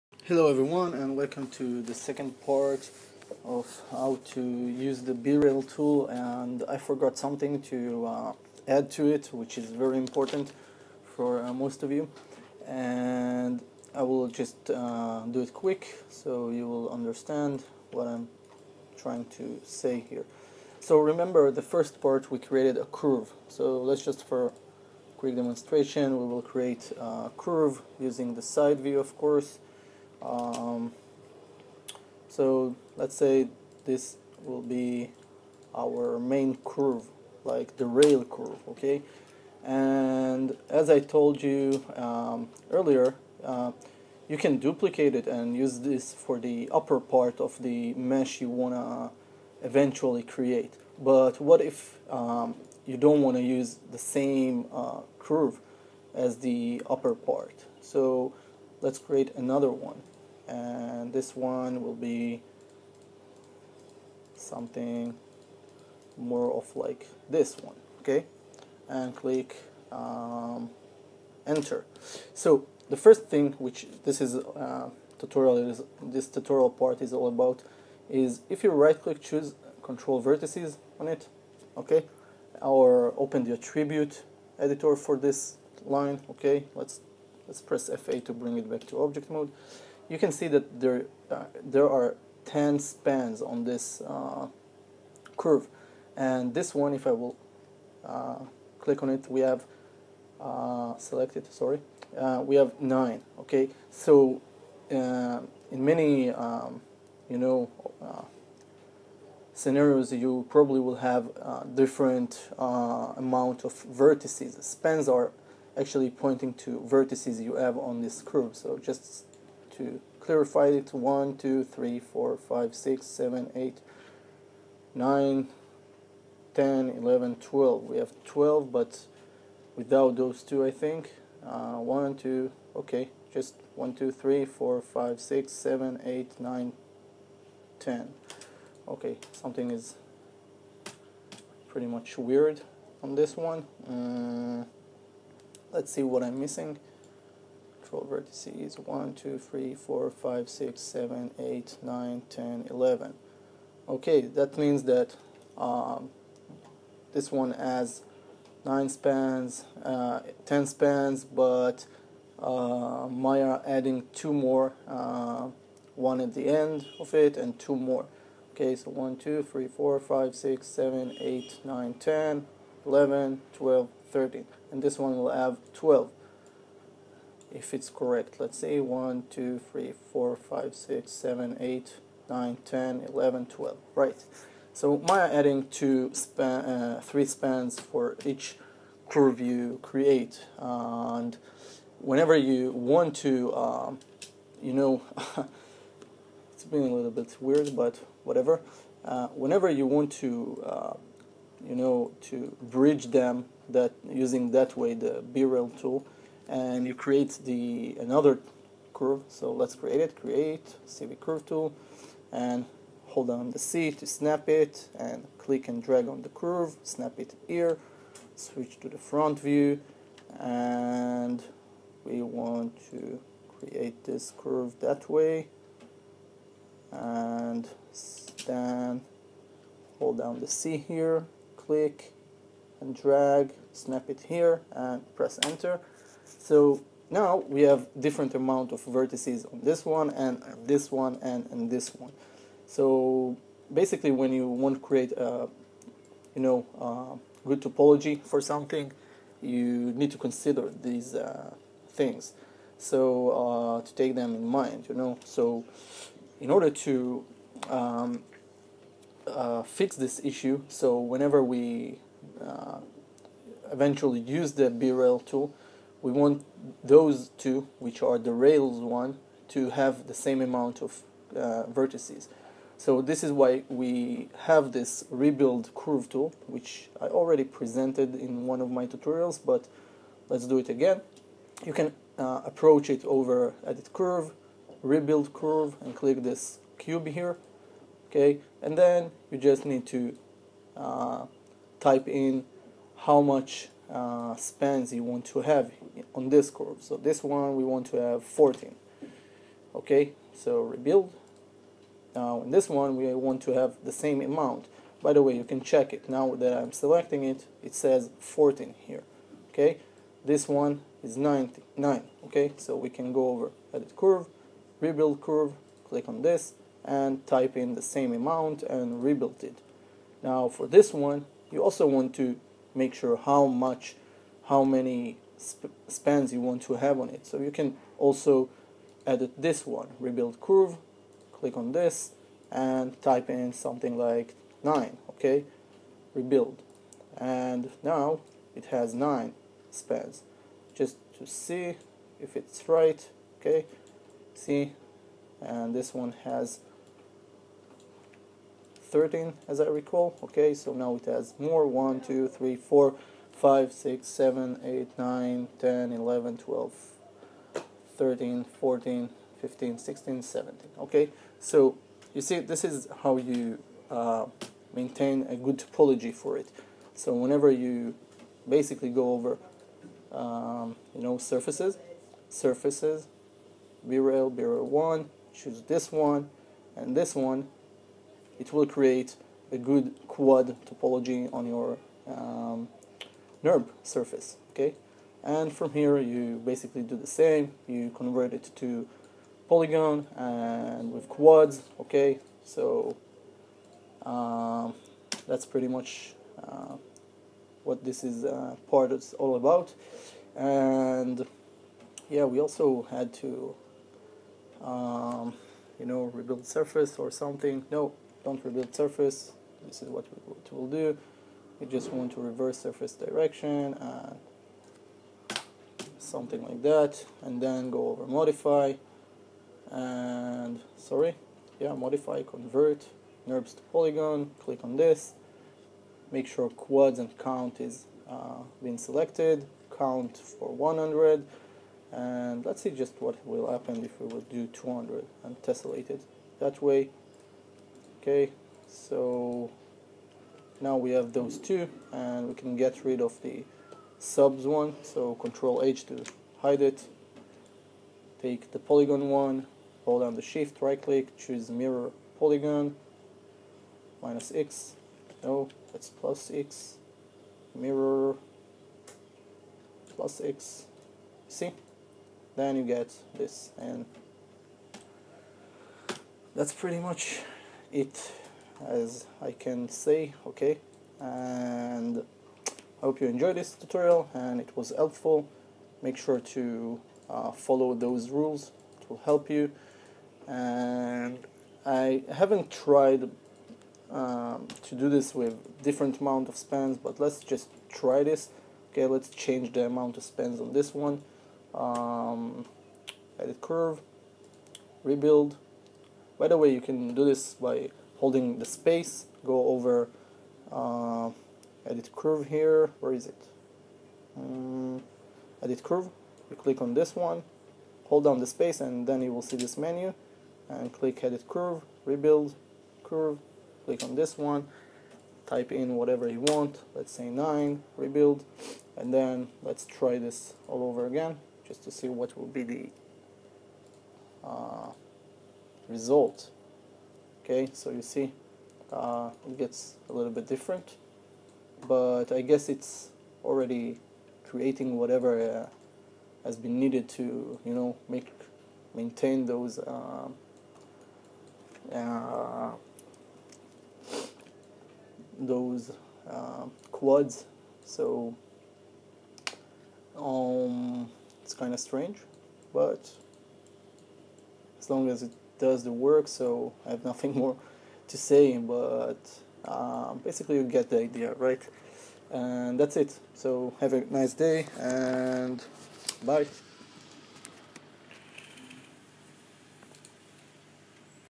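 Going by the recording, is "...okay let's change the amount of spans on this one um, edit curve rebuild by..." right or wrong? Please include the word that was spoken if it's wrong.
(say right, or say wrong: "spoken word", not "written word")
right.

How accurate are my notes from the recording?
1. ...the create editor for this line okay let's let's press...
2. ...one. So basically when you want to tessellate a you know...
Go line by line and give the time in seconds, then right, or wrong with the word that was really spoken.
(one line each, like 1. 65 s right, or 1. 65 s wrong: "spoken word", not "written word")
1. 83 s wrong: "attribute", not "create"
2. 241 s wrong: "create", not "tessellate".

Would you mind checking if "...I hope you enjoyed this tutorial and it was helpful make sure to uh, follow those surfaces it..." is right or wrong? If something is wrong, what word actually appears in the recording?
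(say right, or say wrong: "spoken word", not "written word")
wrong: "rules", not "surfaces".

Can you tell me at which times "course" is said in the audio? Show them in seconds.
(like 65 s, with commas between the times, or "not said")
29 s.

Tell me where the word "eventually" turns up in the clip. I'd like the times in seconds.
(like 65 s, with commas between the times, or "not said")
49 s, 263 s.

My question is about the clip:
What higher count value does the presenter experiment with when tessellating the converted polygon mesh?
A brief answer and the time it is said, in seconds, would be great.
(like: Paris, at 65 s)
200, at 434 s.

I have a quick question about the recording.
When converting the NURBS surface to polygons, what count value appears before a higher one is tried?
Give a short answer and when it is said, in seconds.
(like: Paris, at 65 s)
100, at 429 s.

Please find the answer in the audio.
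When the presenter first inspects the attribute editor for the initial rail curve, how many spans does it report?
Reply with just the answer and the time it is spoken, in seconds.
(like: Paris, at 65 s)
10, at 91 s.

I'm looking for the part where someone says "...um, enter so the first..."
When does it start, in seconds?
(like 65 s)
69 s.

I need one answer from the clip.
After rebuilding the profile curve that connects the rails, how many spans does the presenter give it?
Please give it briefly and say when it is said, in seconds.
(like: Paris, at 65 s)
9, at 333 s.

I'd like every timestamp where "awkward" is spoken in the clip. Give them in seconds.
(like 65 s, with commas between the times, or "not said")
not said.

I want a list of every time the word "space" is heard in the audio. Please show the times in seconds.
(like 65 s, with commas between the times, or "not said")
498 s, 508 s.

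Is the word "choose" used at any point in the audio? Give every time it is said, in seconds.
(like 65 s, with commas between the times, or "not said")
79 s, 375 s, 451 s.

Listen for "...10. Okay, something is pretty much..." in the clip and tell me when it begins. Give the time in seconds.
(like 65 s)
137 s.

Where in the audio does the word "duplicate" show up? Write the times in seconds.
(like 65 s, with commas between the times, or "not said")
44 s.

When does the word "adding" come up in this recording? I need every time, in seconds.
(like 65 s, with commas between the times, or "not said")
163 s, 185 s.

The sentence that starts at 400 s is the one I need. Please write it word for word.
And yeah, we also had to um, you know, rebuild surface or something.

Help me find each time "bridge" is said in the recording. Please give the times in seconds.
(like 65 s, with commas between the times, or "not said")
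202 s.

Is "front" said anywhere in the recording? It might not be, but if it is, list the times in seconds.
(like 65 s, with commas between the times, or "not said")
218 s.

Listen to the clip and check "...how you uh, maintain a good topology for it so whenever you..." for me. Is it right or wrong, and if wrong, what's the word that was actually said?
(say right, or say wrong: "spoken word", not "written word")
right.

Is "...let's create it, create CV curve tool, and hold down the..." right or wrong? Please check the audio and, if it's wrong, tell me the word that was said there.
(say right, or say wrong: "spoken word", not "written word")
right.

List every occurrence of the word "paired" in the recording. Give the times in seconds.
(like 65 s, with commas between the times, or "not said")
not said.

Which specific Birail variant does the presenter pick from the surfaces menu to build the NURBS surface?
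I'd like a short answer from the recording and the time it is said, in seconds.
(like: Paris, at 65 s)
Birail 1, at 374 s.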